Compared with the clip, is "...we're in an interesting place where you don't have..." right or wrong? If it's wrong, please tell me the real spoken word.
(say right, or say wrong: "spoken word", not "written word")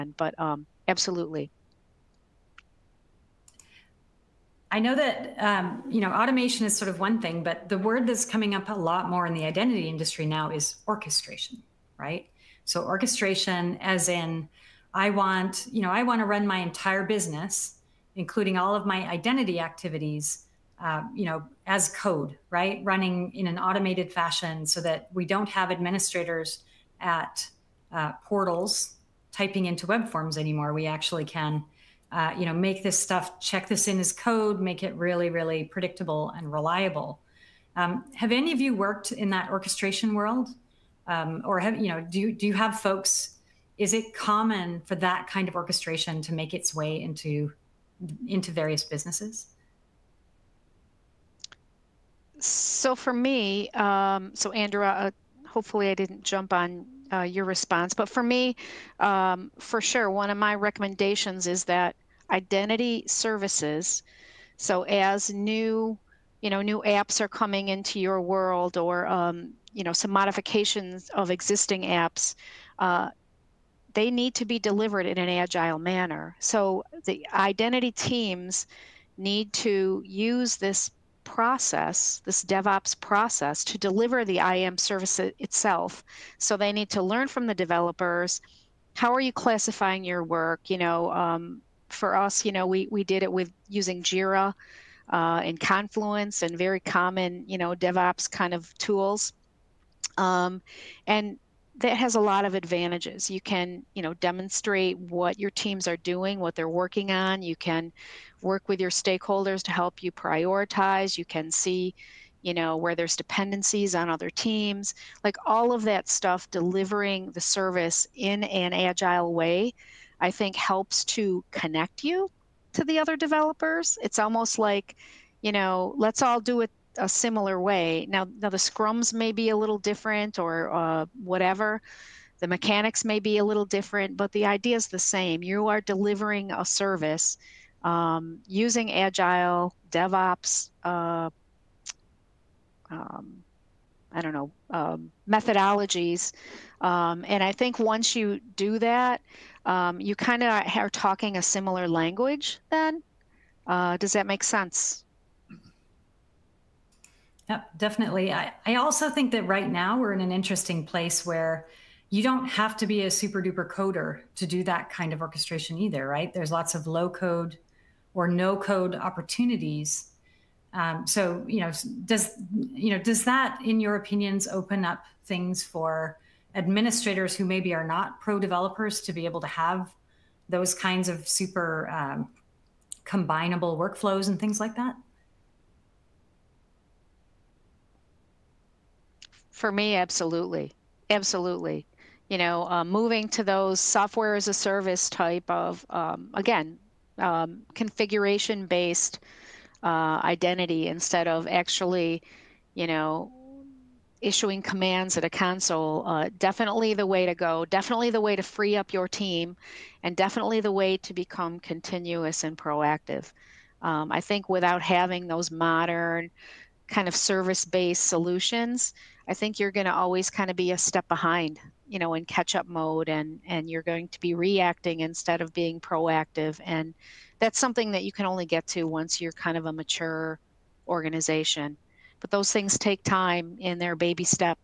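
right.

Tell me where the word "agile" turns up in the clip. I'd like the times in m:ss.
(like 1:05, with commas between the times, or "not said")
1:15, 1:58, 2:18.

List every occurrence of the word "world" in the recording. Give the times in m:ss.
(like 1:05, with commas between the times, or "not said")
0:40, 1:08.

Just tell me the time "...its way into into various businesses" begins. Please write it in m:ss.
0:46.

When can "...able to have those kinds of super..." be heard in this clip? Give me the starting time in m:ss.
2:59.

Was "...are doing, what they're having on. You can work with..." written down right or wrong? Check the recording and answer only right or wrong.
wrong.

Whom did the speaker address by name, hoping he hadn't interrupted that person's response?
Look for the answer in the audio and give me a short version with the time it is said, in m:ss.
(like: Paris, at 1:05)
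Andrew, at 0:54.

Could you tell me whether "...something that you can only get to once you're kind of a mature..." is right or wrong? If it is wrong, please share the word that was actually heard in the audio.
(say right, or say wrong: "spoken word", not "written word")
right.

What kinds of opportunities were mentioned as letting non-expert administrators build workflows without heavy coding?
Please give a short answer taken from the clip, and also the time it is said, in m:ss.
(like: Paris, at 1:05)
Low code or no code, at 2:46.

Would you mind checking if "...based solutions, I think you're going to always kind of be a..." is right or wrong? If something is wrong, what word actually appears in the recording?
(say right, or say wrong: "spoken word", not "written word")
right.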